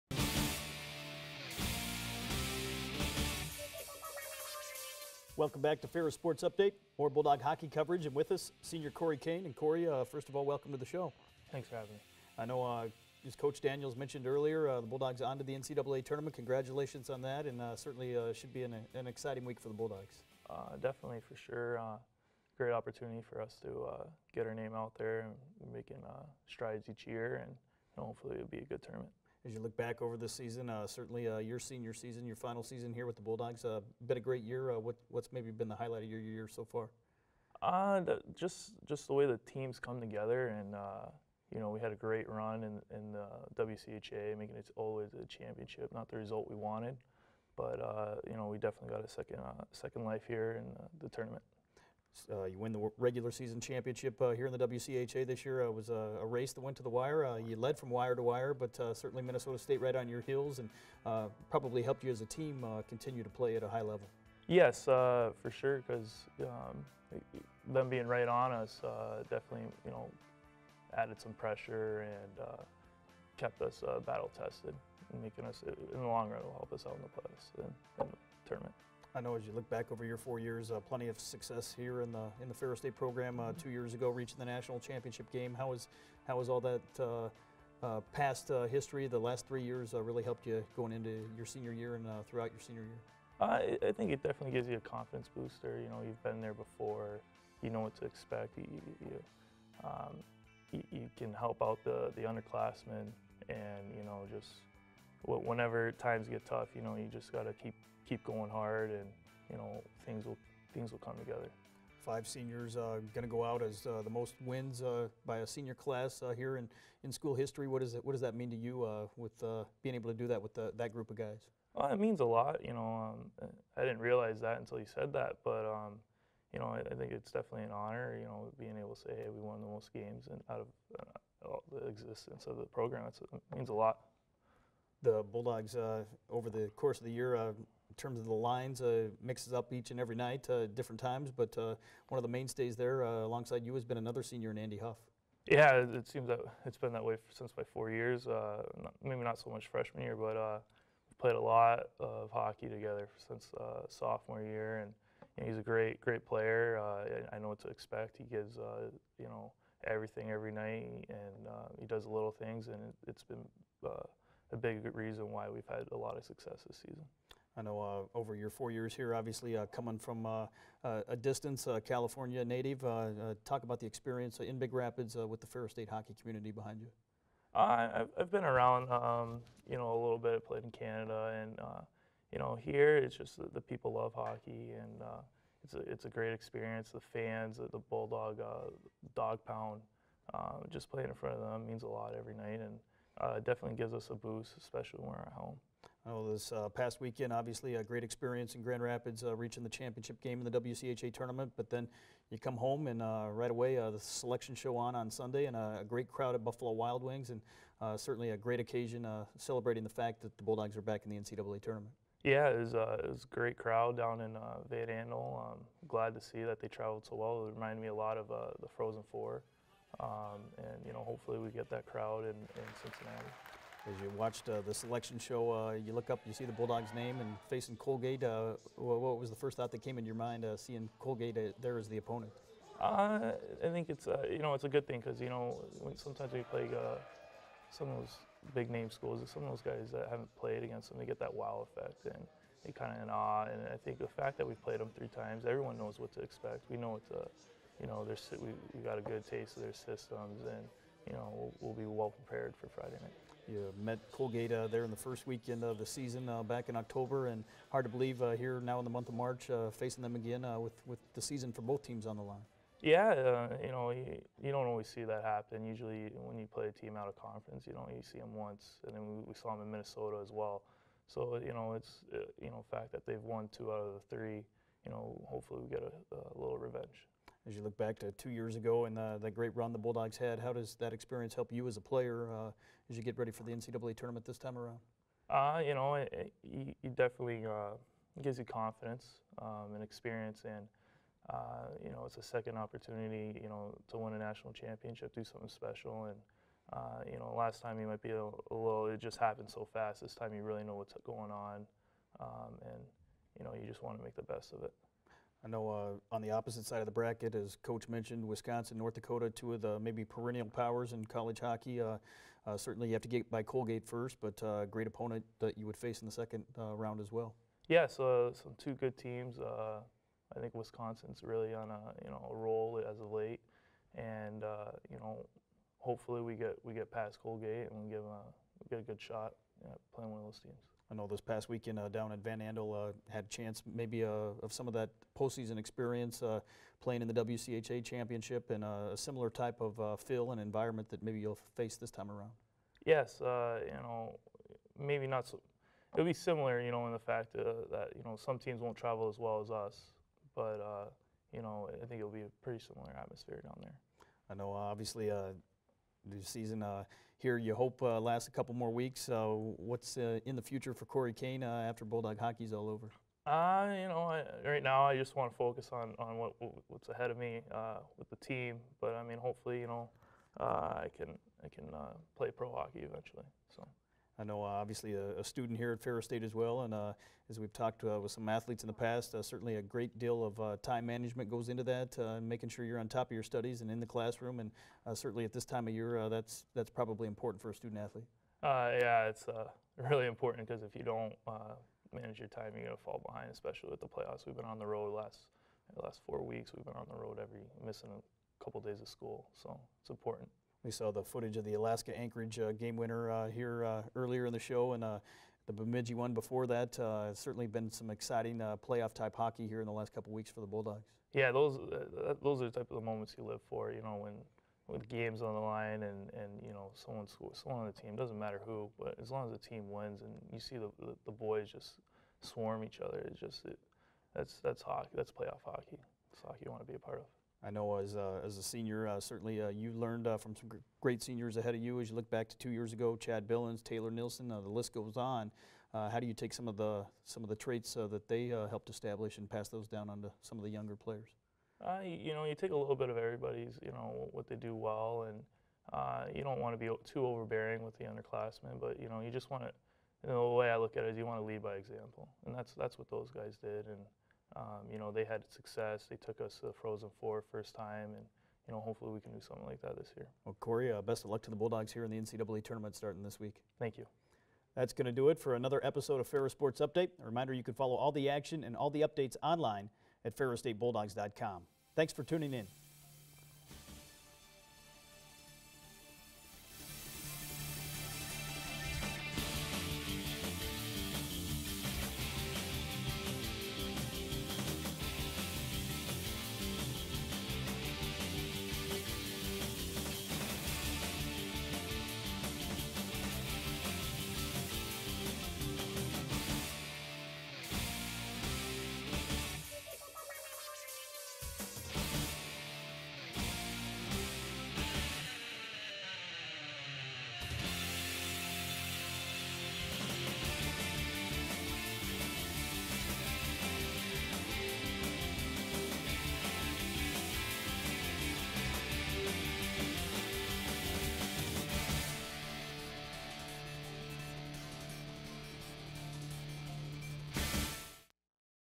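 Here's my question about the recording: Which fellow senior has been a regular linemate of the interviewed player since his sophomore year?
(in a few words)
Andy Huff.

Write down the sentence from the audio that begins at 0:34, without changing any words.
Uh, what, what's maybe been the highlight of your year so far?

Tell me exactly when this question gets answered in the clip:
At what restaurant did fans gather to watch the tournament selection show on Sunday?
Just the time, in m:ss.
3:26.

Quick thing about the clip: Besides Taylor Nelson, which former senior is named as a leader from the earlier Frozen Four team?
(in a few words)
Chad Billins.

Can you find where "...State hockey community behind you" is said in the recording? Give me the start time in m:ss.
2:55.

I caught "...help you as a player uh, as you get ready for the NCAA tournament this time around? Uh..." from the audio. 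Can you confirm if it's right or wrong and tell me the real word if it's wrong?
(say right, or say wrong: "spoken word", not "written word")
right.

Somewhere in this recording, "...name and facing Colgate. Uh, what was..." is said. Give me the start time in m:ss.
3:46.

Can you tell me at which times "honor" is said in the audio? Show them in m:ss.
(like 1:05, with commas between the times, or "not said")
2:07.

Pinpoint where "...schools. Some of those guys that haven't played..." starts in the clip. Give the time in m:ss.
3:58.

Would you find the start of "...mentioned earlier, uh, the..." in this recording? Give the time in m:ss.
0:13.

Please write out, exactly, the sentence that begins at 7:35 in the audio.
They took us to the Frozen Four first time, and you know, hopefully we can do something like that this year.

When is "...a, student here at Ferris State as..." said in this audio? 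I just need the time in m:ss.
6:15.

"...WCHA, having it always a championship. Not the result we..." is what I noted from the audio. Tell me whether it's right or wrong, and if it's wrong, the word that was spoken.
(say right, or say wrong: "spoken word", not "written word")
wrong: "making", not "having".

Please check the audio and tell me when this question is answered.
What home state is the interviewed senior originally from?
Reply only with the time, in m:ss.
2:51.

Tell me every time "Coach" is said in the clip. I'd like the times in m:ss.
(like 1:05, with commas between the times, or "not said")
0:13, 5:07.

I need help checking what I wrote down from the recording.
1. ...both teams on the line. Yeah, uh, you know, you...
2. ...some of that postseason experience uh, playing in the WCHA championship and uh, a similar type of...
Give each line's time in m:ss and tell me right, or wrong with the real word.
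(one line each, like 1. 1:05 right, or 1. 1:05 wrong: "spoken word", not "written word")
1. 4:21 right
2. 5:34 right.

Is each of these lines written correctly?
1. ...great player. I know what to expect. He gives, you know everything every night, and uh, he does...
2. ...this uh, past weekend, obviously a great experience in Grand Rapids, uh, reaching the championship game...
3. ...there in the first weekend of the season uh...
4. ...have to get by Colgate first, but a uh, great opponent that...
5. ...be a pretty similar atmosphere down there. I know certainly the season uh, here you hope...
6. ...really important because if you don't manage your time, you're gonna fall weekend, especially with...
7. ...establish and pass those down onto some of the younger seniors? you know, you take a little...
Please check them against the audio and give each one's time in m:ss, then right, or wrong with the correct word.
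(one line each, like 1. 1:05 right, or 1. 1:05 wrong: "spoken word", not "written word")
1. 2:36 right
2. 3:16 right
3. 4:14 right
4. 5:12 right
5. 5:52 wrong: "obviously", not "certainly"
6. 6:29 wrong: "behind", not "weekend"
7. 7:18 wrong: "players", not "seniors".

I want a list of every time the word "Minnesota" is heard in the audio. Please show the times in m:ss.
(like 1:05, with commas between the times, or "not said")
0:59, 4:29.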